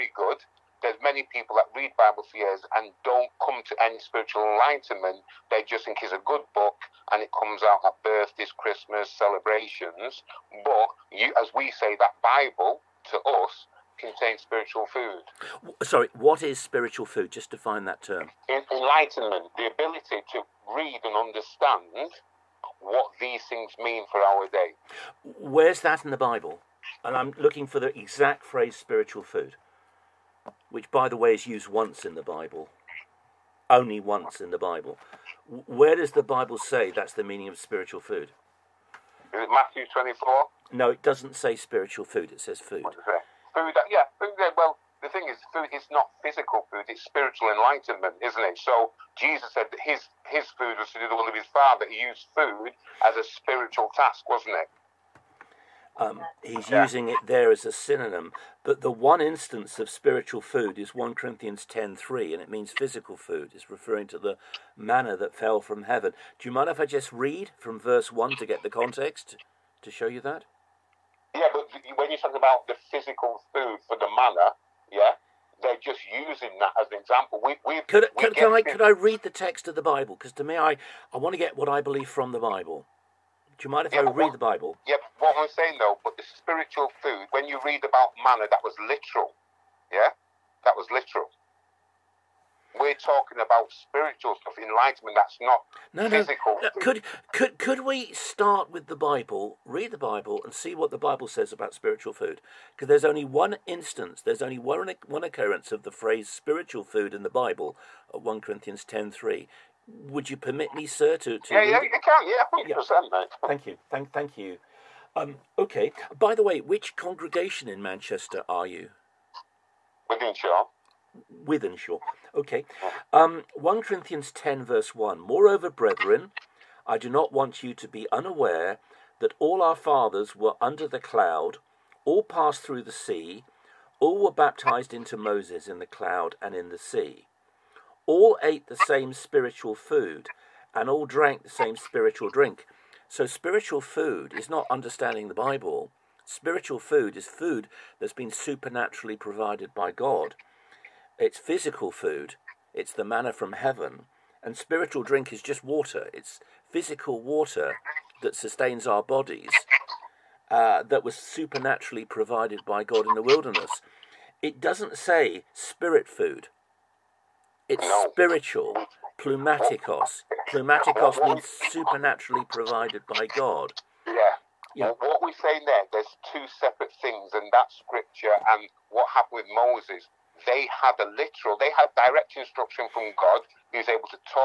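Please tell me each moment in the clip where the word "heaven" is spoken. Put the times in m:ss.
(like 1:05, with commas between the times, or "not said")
1:05, 2:33.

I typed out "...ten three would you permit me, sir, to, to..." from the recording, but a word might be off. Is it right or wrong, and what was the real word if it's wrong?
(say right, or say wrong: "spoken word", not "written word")
right.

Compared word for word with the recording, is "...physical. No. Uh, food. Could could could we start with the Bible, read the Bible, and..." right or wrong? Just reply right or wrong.
right.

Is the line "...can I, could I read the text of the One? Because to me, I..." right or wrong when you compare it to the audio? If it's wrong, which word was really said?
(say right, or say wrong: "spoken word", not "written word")
wrong: "Bible", not "One".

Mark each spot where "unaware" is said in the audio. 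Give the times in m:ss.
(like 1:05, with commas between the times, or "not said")
2:08.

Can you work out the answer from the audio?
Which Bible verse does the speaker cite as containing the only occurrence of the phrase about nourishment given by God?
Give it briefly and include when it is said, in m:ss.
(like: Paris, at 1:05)
1 Corinthians 10:3, at 1:00.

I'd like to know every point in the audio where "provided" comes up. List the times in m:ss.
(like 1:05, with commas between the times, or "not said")
2:29, 2:42, 2:52.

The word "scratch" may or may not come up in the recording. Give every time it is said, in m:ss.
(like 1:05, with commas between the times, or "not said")
not said.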